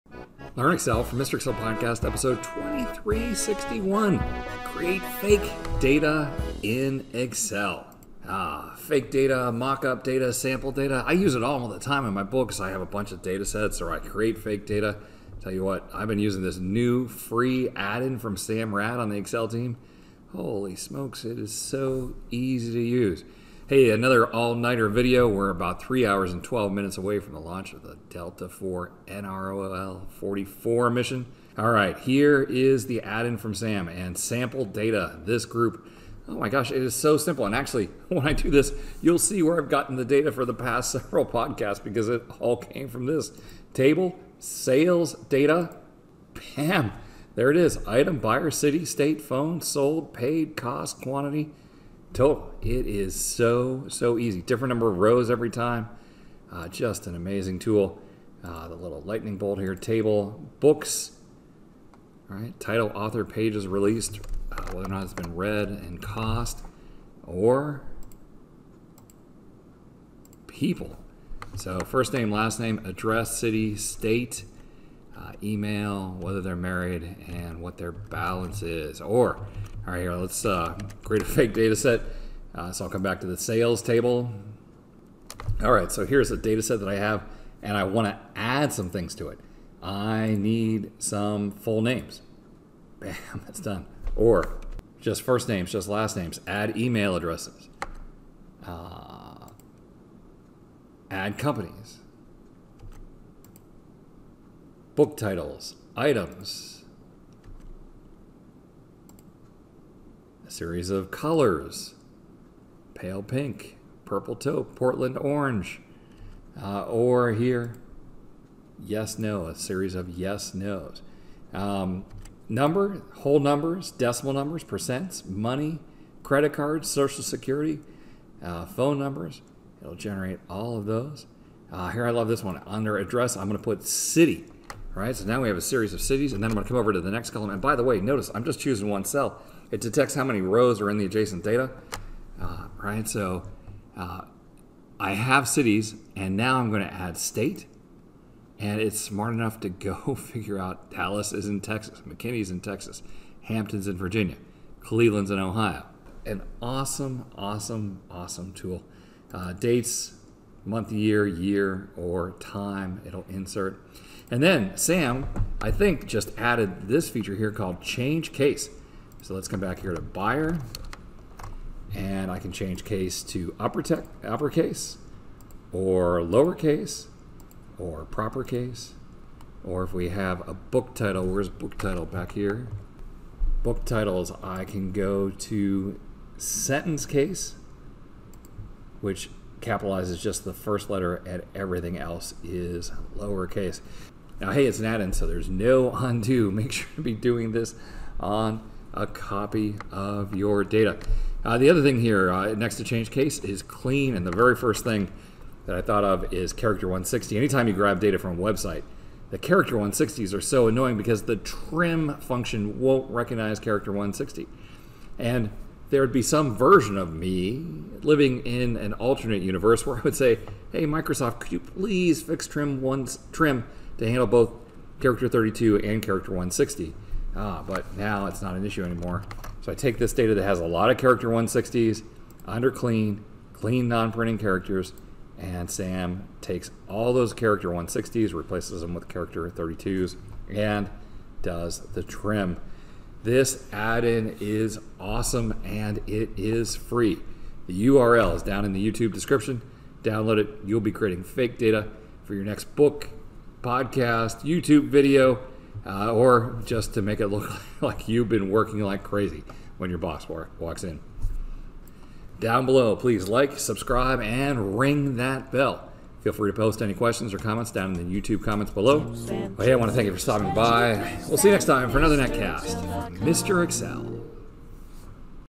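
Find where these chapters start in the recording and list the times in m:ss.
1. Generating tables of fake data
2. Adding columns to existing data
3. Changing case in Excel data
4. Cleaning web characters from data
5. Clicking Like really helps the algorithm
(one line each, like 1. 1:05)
1. 0:32
2. 1:19
3. 2:50
4. 3:21
5. 4:07.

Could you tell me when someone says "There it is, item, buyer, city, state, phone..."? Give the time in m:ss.
0:47.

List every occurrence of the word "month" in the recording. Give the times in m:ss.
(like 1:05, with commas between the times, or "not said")
2:40.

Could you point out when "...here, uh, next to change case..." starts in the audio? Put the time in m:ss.
3:22.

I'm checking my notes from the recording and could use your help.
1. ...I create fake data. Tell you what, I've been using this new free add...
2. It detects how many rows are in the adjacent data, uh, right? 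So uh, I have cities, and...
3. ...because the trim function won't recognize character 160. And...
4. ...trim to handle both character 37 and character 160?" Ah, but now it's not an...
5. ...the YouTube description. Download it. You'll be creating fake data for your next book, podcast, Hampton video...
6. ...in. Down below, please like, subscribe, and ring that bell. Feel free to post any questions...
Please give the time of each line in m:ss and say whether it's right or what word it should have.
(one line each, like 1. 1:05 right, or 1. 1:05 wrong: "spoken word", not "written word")
1. 0:13 right
2. 2:19 right
3. 3:30 right
4. 3:43 wrong: "32", not "37"
5. 4:08 wrong: "YouTube", not "Hampton"
6. 4:20 right.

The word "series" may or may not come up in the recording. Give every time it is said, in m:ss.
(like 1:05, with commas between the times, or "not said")
1:50, 1:59, 2:15.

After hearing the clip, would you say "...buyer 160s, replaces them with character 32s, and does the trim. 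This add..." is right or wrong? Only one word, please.
wrong.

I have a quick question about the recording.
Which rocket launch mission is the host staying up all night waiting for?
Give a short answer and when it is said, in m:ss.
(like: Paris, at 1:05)
Delta IV NROL 44, at 0:28.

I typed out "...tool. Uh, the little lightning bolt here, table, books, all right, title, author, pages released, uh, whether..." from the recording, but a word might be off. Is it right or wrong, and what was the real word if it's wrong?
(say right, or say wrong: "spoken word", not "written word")
right.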